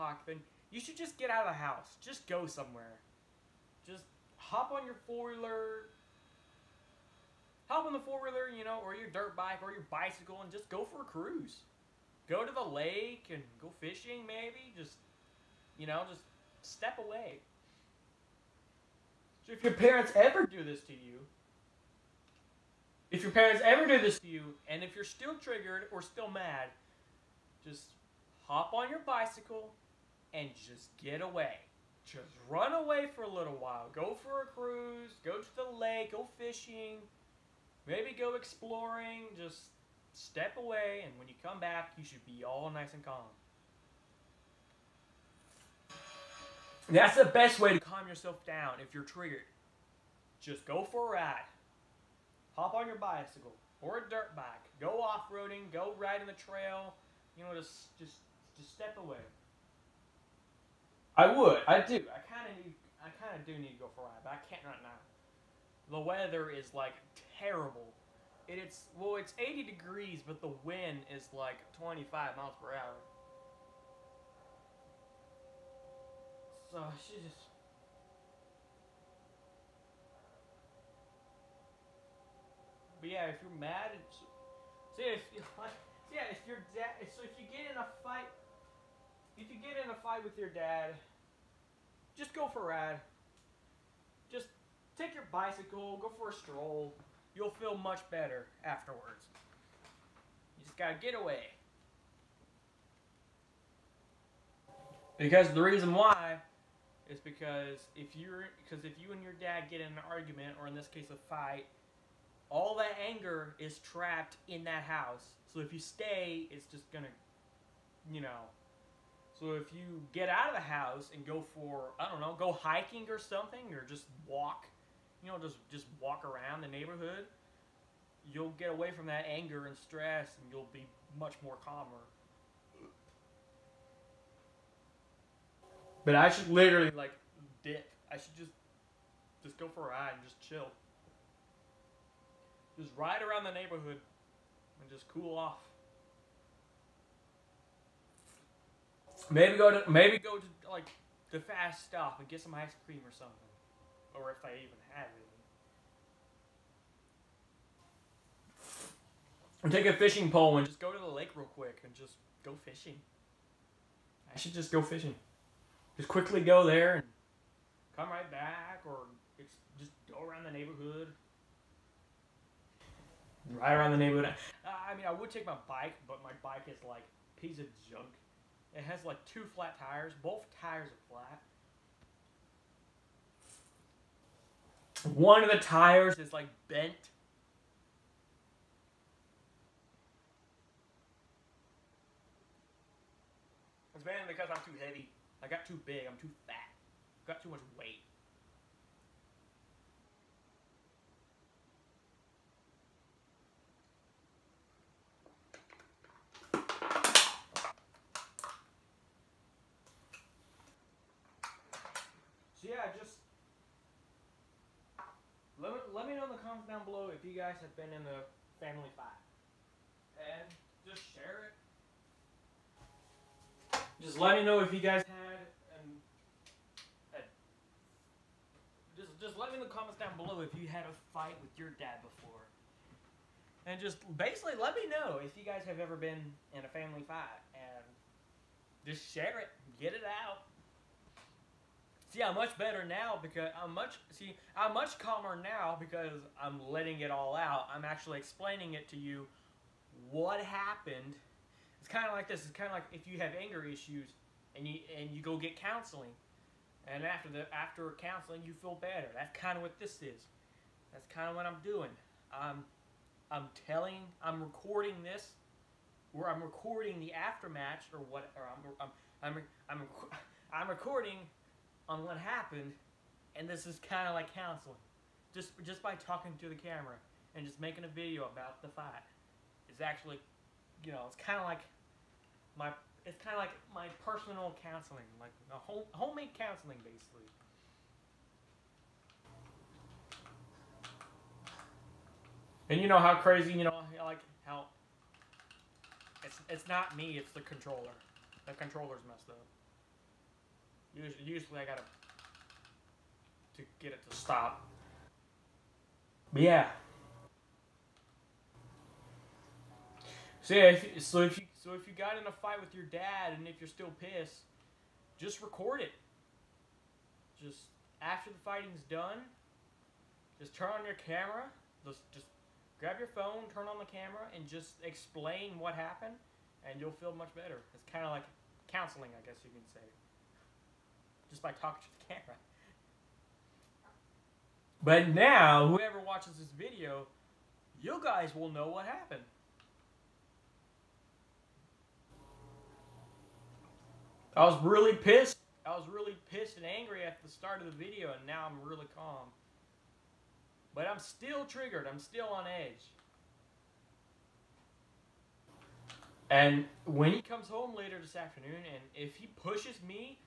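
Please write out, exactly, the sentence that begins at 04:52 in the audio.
And you know how crazy, you know, like how it's it's not me, it's the controller.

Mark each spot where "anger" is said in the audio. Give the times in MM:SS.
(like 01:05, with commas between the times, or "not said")
01:53, 02:09, 04:13.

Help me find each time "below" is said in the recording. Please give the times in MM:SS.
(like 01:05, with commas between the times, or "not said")
03:36, 03:50.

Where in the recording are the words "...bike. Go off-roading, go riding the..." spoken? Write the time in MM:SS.
00:54.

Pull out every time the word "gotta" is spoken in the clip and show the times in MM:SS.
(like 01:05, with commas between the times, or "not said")
01:40, 05:01.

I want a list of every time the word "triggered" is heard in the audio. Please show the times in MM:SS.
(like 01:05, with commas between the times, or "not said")
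00:25, 00:49, 05:51.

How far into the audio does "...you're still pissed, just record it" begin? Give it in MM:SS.
05:13.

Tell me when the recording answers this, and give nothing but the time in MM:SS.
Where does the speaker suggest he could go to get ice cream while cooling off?
02:31.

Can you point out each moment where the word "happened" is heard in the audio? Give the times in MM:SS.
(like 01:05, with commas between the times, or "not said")
04:10, 04:32, 05:25, 05:38.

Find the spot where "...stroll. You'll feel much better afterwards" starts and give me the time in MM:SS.
01:36.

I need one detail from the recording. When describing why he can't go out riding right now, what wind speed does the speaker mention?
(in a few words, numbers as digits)
25 miles per hour.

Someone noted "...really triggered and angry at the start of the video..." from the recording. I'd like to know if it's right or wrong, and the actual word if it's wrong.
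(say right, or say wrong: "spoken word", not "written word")
wrong: "pissed", not "triggered".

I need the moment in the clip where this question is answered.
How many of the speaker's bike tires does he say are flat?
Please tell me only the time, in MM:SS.
02:59.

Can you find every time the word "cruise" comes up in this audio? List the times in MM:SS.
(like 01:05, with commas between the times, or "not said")
00:11, 00:34.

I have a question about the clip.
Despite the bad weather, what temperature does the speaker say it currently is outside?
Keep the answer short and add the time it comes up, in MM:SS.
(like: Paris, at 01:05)
80 degrees, at 01:09.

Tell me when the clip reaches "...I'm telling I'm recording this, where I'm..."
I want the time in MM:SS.
04:23.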